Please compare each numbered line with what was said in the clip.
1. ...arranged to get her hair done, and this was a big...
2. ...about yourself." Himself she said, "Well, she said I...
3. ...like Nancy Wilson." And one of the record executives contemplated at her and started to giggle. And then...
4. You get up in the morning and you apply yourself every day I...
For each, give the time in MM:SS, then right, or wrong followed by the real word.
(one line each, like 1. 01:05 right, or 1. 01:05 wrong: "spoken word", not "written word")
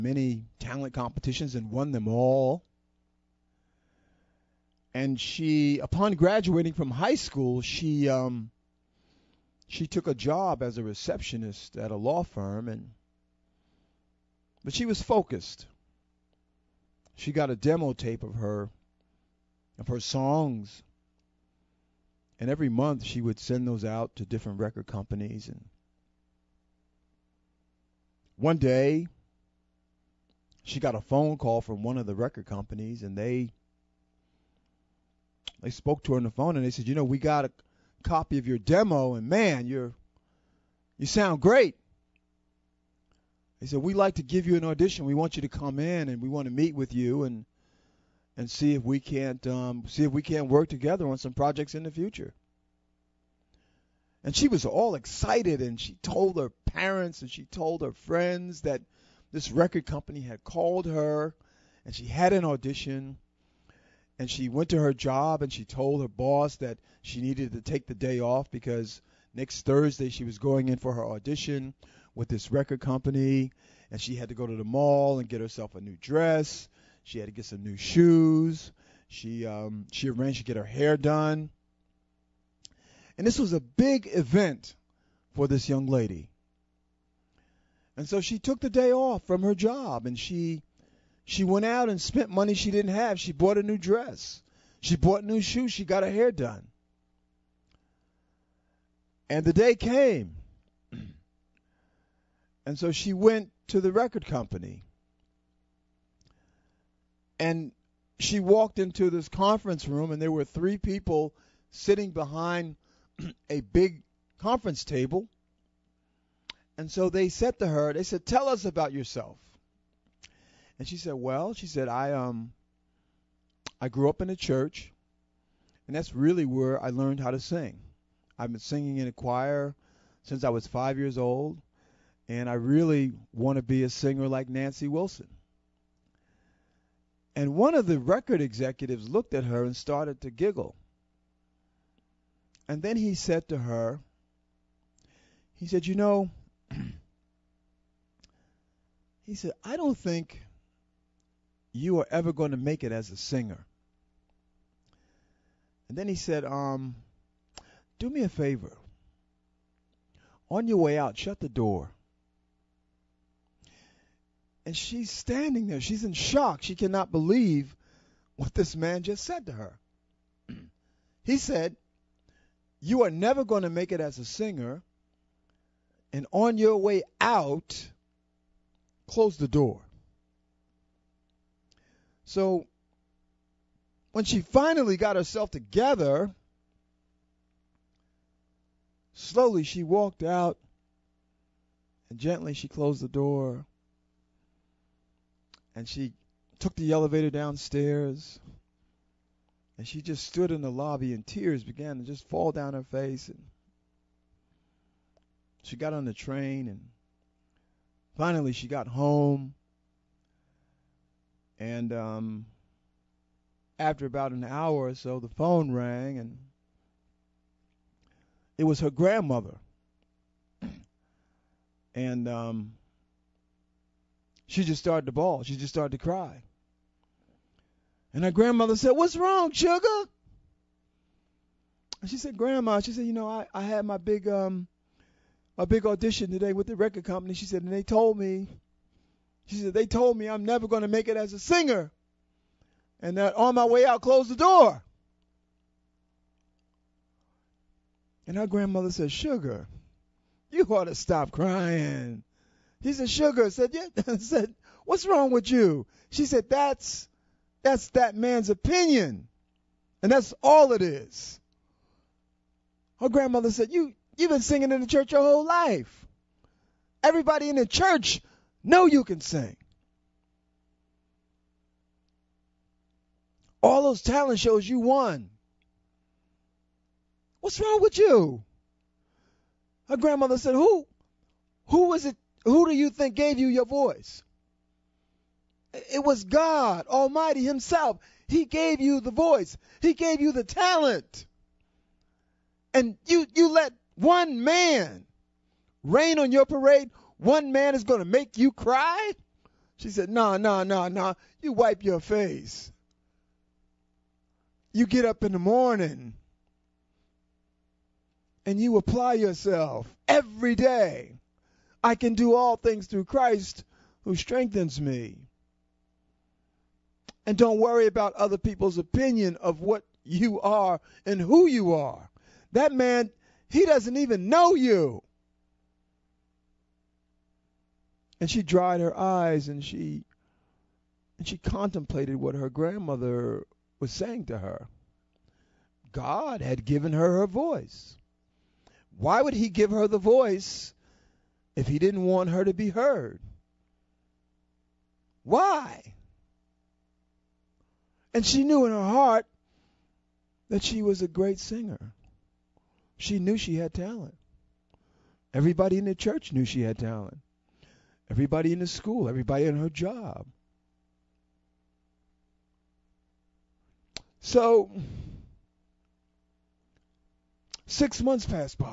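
1. 01:20 right
2. 01:58 wrong: "And", not "Himself"
3. 02:14 wrong: "looked", not "contemplated"
4. 05:04 right.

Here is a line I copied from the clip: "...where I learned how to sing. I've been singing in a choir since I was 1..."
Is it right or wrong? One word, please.
wrong.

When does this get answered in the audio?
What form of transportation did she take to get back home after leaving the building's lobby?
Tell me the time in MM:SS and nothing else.
03:26.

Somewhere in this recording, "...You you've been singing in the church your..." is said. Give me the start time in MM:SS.
04:23.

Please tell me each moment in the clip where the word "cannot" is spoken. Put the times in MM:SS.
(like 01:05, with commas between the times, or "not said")
02:46.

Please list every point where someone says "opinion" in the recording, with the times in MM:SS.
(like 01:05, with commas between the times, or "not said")
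04:18, 05:18.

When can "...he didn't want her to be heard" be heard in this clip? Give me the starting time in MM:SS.
05:41.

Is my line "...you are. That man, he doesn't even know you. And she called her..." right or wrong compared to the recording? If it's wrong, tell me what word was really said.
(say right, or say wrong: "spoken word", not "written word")
wrong: "dried", not "called".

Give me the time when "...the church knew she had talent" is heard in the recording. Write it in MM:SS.
05:55.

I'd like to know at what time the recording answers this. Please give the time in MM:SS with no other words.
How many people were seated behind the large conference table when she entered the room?
01:50.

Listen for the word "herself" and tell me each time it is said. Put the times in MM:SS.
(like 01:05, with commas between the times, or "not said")
01:15, 03:05.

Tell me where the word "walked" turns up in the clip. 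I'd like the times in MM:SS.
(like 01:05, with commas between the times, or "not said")
01:48, 03:09.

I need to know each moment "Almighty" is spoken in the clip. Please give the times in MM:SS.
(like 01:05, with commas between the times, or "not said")
04:46.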